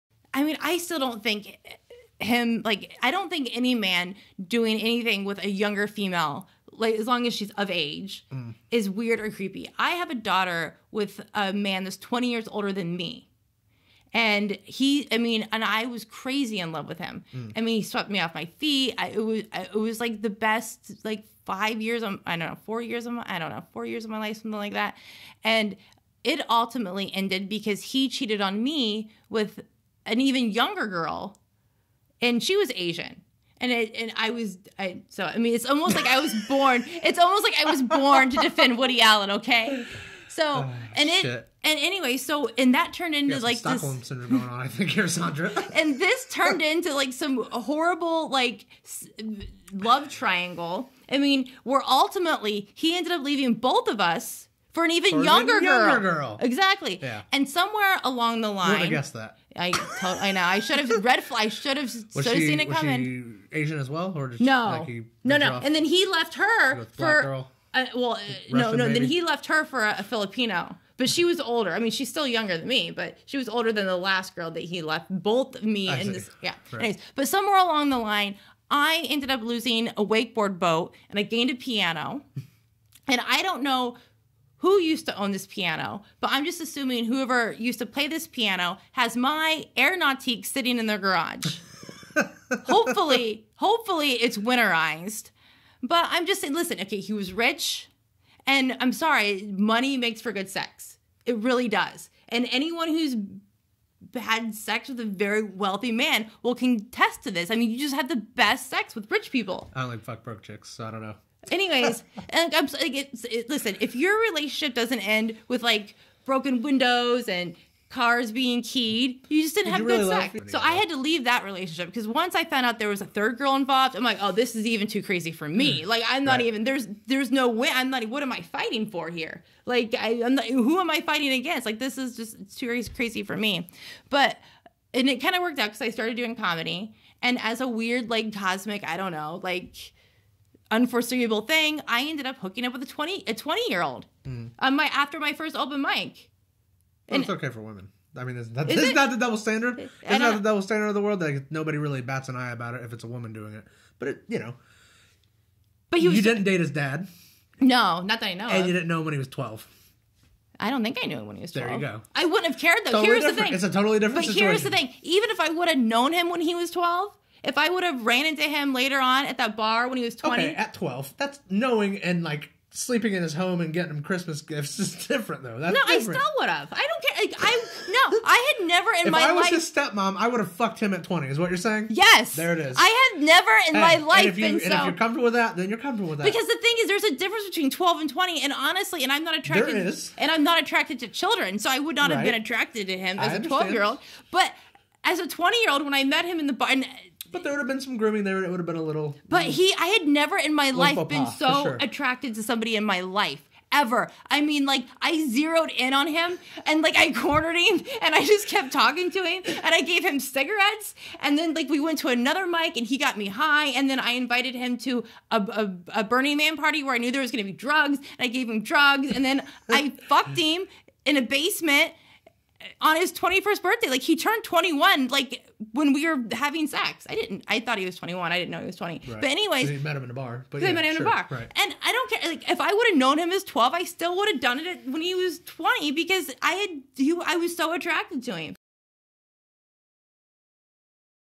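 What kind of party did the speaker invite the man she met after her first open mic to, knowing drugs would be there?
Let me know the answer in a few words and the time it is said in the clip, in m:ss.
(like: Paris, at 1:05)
Burning Man party, at 3:36.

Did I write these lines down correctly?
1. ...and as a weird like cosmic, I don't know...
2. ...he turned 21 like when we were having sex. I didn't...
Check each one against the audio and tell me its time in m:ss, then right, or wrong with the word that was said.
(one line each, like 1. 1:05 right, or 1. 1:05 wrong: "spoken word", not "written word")
1. 2:17 right
2. 3:44 right.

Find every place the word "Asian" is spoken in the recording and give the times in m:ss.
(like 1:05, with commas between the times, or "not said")
0:32, 1:03.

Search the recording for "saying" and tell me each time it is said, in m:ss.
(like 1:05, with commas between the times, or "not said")
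1:36, 3:01.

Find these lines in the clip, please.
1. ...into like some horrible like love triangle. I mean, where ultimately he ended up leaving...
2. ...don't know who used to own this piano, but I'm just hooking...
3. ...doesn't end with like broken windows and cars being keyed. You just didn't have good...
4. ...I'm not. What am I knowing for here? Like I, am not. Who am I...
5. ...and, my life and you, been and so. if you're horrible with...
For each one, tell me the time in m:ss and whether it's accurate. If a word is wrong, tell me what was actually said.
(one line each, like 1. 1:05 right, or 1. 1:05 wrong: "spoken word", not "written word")
1. 0:46 right
2. 1:23 wrong: "assuming", not "hooking"
3. 1:54 right
4. 2:07 wrong: "fighting", not "knowing"
5. 3:03 wrong: "comfortable", not "horrible".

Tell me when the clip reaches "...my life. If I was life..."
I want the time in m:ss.
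2:59.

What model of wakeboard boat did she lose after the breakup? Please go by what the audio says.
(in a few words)
Air Nautique.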